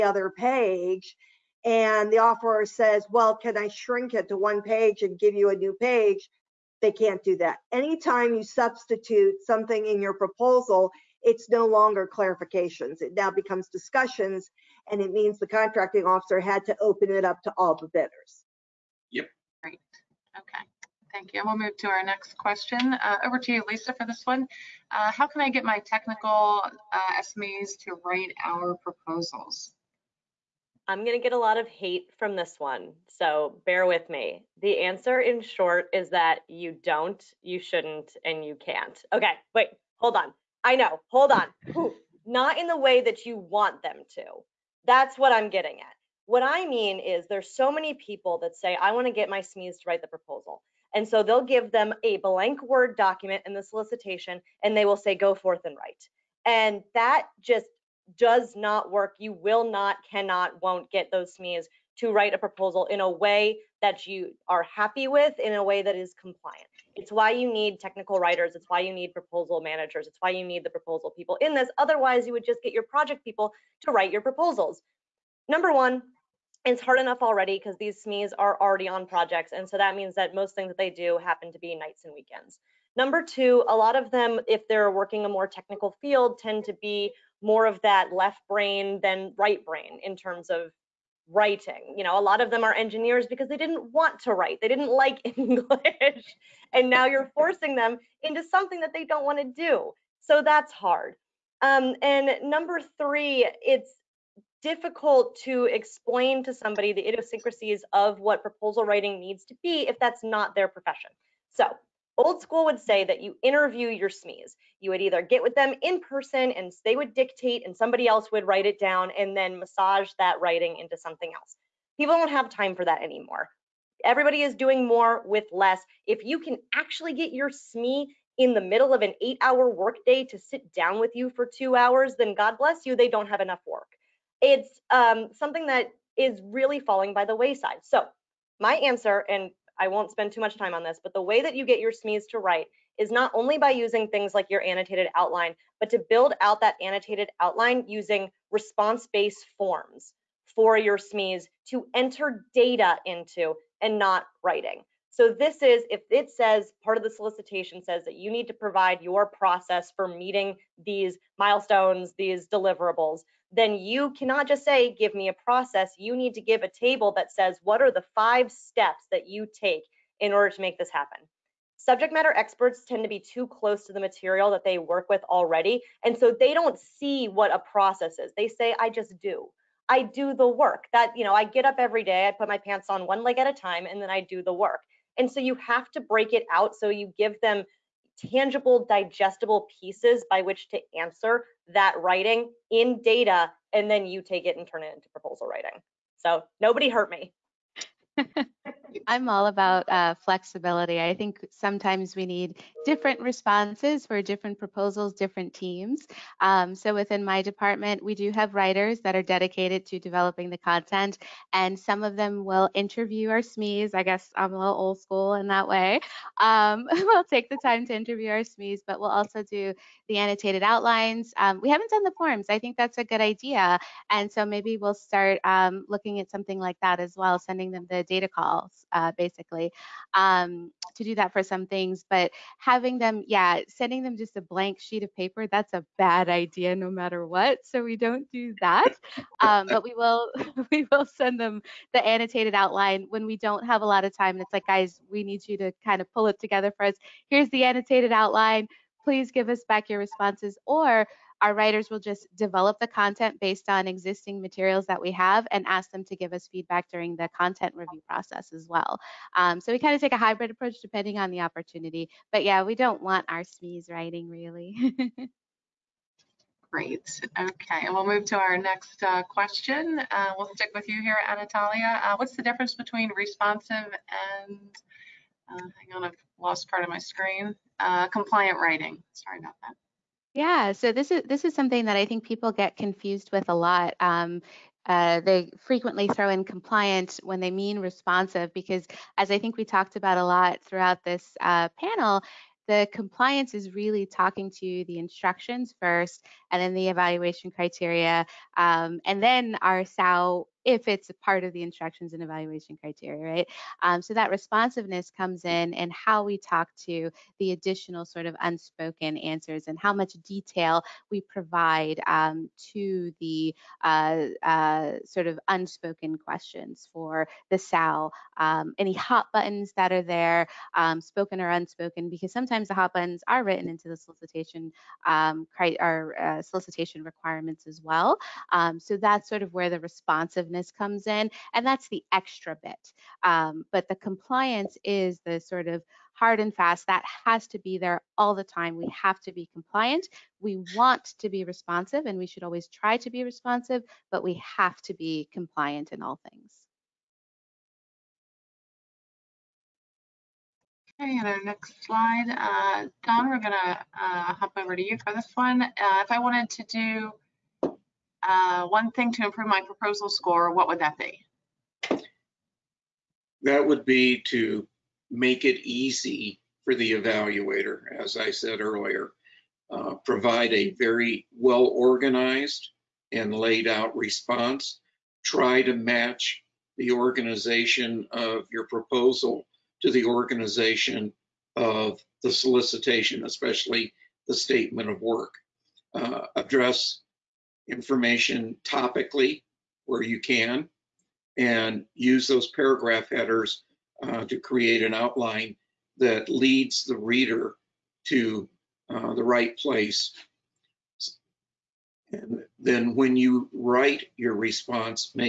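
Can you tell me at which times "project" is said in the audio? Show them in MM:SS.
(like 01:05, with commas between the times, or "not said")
01:12, 01:19.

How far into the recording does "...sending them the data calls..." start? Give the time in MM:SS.
03:47.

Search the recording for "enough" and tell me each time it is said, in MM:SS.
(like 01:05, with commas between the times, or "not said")
01:16, 02:13.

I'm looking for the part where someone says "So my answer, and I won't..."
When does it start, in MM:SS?
02:17.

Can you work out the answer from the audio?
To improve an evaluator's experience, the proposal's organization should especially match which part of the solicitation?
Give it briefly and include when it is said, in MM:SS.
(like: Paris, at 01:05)
statement of work, at 06:24.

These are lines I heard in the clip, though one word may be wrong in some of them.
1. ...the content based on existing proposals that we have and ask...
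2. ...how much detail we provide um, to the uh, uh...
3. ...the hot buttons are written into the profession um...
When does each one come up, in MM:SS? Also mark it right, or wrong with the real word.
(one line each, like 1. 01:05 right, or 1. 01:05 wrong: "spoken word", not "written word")
1. 04:12 wrong: "materials", not "proposals"
2. 05:09 right
3. 05:22 wrong: "solicitation", not "profession".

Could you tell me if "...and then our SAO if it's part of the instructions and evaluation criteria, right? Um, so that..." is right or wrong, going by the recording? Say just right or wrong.
right.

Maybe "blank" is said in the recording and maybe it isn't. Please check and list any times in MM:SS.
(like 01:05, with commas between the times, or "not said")
00:52, 03:54.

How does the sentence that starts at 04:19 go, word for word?
Um, so we kind of take a hybrid approach depending on the opportunity.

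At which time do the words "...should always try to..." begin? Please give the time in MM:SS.
05:42.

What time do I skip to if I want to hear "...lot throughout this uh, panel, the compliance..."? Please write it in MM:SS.
04:50.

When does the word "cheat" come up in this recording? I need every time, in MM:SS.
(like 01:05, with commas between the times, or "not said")
not said.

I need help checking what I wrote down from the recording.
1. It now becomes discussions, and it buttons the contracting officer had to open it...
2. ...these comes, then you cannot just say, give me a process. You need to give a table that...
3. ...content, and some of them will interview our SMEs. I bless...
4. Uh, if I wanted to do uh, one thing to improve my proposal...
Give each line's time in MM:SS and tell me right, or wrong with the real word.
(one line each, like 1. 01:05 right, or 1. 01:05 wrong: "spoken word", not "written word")
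1. 00:13 wrong: "means", not "buttons"
2. 02:42 wrong: "deliverables", not "comes"
3. 03:30 wrong: "guess", not "bless"
4. 05:55 right.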